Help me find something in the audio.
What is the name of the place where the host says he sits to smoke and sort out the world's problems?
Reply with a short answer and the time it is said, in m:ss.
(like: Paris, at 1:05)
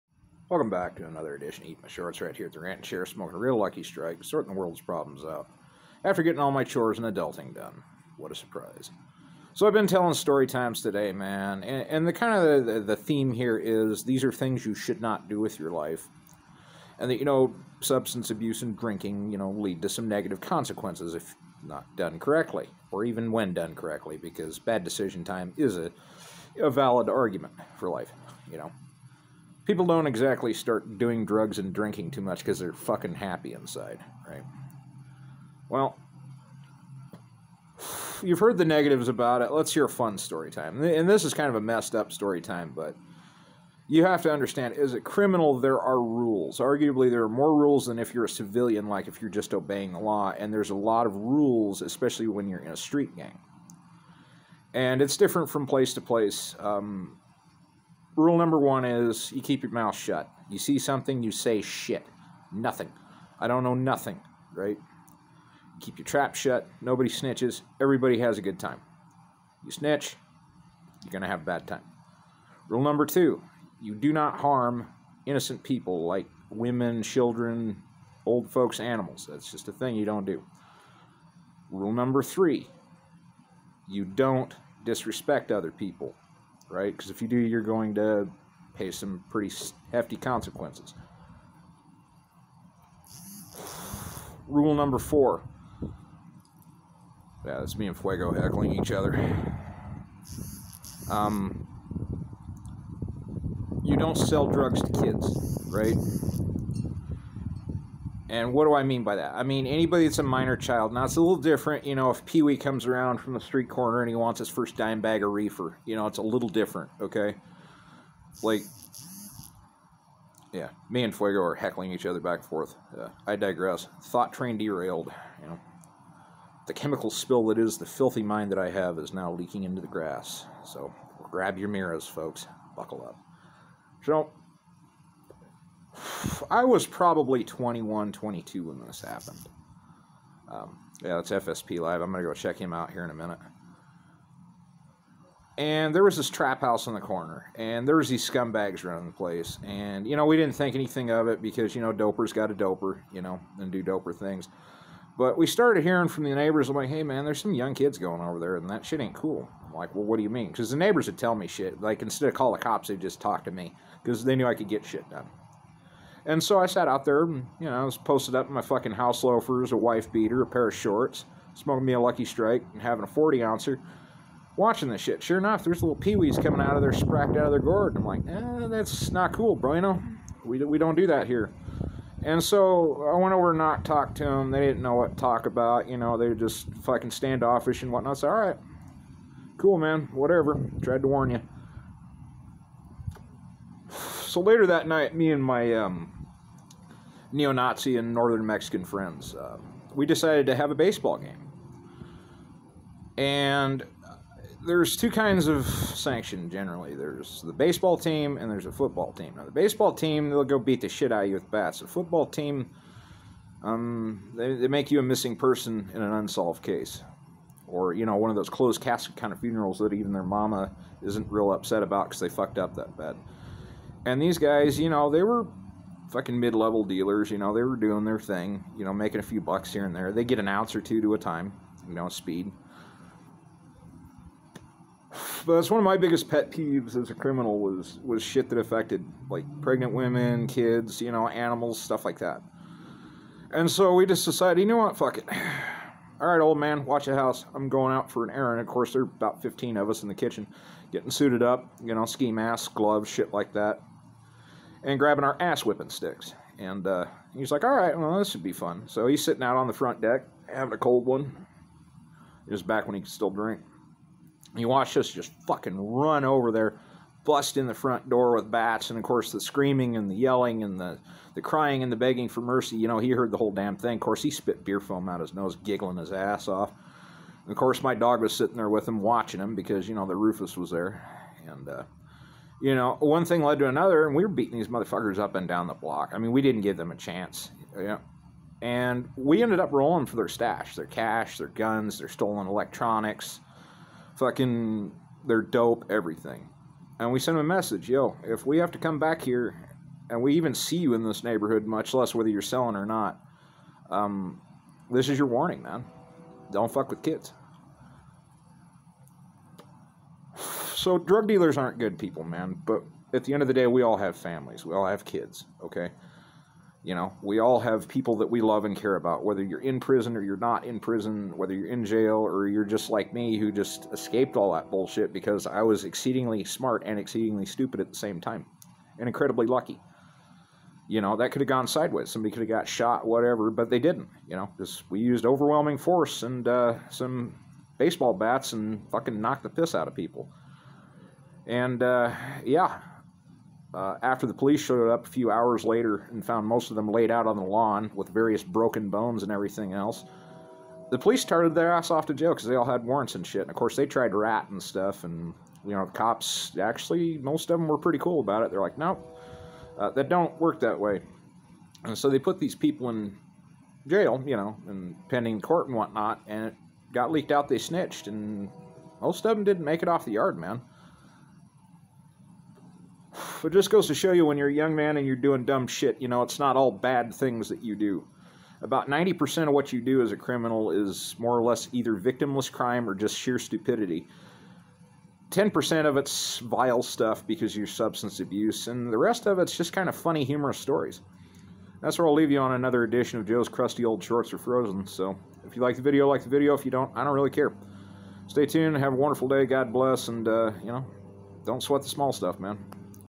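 Rant and Chair, at 0:02.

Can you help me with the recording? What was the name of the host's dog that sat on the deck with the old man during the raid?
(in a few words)
Rufus.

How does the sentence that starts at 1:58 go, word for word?
Like yeah, me and Fuego are heckling each other back and forth.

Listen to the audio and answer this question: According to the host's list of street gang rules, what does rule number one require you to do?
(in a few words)
Keep your mouth shut.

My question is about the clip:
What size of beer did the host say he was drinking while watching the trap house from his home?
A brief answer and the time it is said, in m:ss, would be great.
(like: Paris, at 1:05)
40 ouncer, at 2:53.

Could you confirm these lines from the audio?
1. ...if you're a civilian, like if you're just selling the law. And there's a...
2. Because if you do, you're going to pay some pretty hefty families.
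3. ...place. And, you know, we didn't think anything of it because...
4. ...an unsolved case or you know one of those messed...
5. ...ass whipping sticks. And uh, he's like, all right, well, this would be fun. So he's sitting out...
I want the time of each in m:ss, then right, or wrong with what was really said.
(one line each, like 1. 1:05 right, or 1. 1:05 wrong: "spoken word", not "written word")
1. 0:47 wrong: "obeying", not "selling"
2. 1:26 wrong: "consequences", not "families"
3. 2:29 right
4. 3:36 wrong: "closed", not "messed"
5. 4:15 right.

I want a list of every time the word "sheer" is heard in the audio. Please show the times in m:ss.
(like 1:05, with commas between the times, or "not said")
6:23.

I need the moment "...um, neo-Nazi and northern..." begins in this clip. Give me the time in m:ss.
3:15.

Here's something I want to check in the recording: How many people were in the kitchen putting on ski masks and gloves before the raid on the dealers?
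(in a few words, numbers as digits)
15.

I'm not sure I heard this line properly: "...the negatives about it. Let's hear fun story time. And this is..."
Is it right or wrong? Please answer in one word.
right.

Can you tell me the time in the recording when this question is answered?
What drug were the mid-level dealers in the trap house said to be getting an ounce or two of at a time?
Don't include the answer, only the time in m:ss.
3:52.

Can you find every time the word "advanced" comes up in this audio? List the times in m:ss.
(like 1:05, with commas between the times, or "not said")
not said.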